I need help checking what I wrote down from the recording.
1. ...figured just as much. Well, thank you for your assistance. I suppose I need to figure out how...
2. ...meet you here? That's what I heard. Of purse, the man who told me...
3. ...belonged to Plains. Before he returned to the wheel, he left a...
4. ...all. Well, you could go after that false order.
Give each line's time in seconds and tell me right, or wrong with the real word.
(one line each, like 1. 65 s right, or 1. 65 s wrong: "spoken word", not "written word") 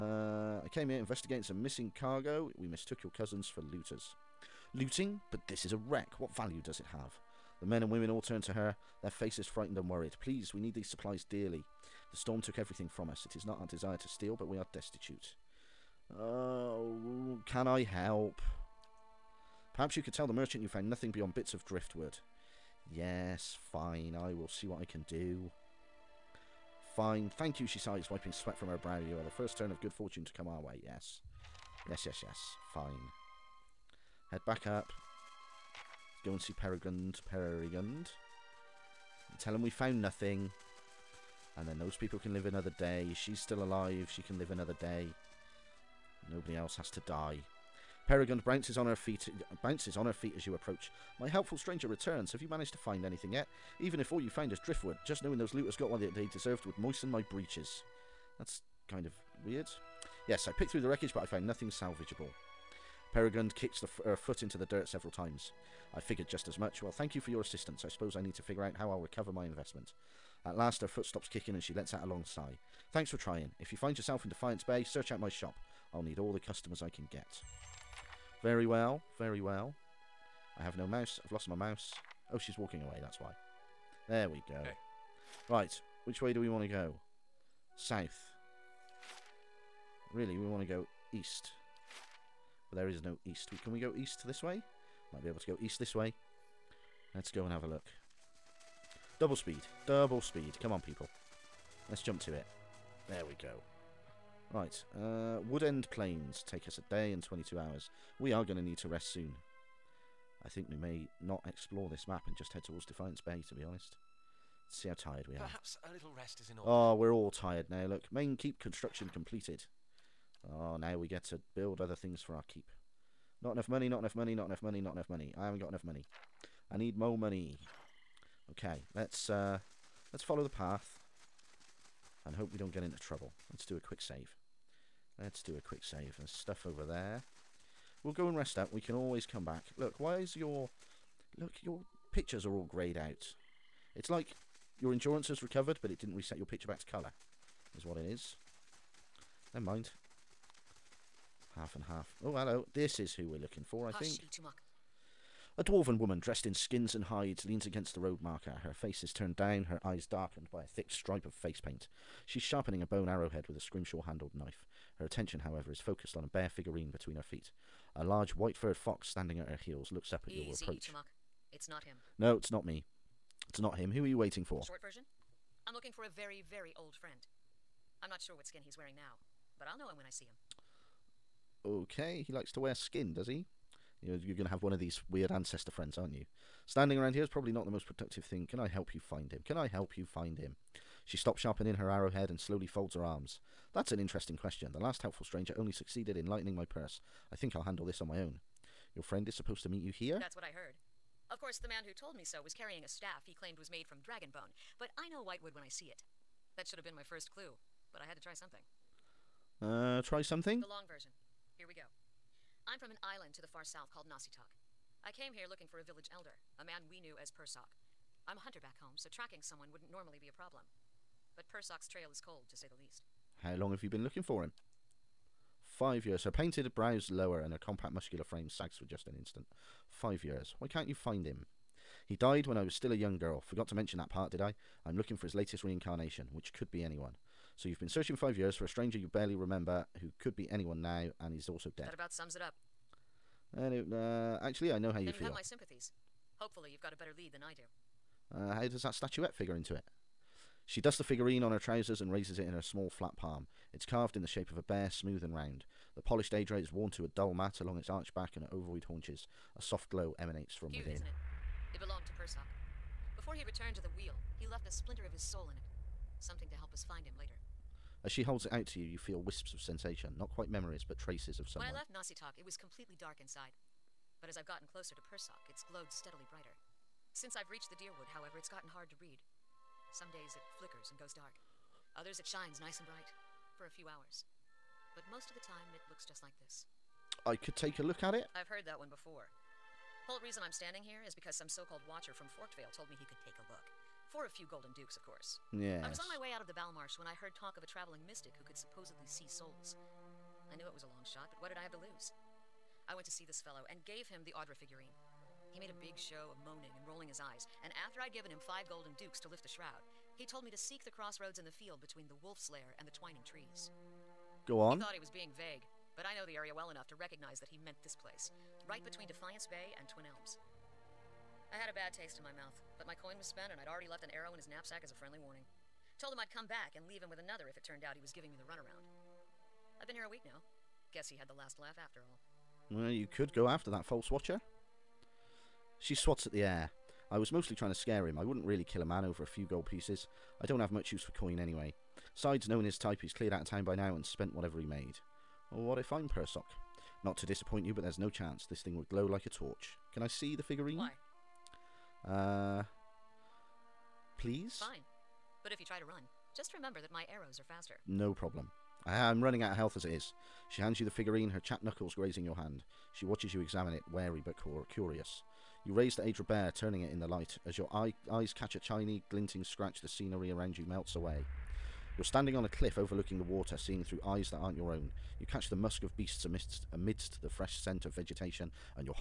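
1. 65 s right
2. 199 s wrong: "course", not "purse"
3. 261 s wrong: "Persoq", not "Plains"
4. 332 s wrong: "watcher", not "order".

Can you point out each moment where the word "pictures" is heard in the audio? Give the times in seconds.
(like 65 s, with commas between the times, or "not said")
142 s, 146 s.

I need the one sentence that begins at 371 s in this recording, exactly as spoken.
You're standing on a cliff overlooking the water, seeing through eyes that aren't your own.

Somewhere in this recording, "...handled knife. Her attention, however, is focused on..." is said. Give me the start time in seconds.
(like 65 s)
164 s.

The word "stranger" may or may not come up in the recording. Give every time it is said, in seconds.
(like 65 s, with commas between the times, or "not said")
51 s, 195 s, 238 s.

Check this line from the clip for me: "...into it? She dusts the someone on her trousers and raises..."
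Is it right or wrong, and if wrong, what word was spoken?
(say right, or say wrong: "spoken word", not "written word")
wrong: "figurine", not "someone".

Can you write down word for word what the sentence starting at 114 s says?
Let's see how tired we are.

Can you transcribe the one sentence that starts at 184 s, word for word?
You're, you're going to have one of these weird ancestor friends, aren't you?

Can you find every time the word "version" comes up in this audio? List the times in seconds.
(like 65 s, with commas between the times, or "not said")
174 s, 210 s.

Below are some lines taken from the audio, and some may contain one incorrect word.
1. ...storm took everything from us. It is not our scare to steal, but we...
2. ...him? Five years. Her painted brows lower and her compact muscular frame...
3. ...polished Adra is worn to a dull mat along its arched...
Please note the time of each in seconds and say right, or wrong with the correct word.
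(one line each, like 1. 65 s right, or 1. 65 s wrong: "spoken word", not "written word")
1. 12 s wrong: "desire", not "scare"
2. 224 s right
3. 256 s right.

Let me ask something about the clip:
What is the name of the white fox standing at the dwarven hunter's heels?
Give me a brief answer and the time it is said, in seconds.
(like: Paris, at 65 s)
Itumaak, at 170 s.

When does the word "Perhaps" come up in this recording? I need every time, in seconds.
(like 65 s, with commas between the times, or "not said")
19 s, 115 s.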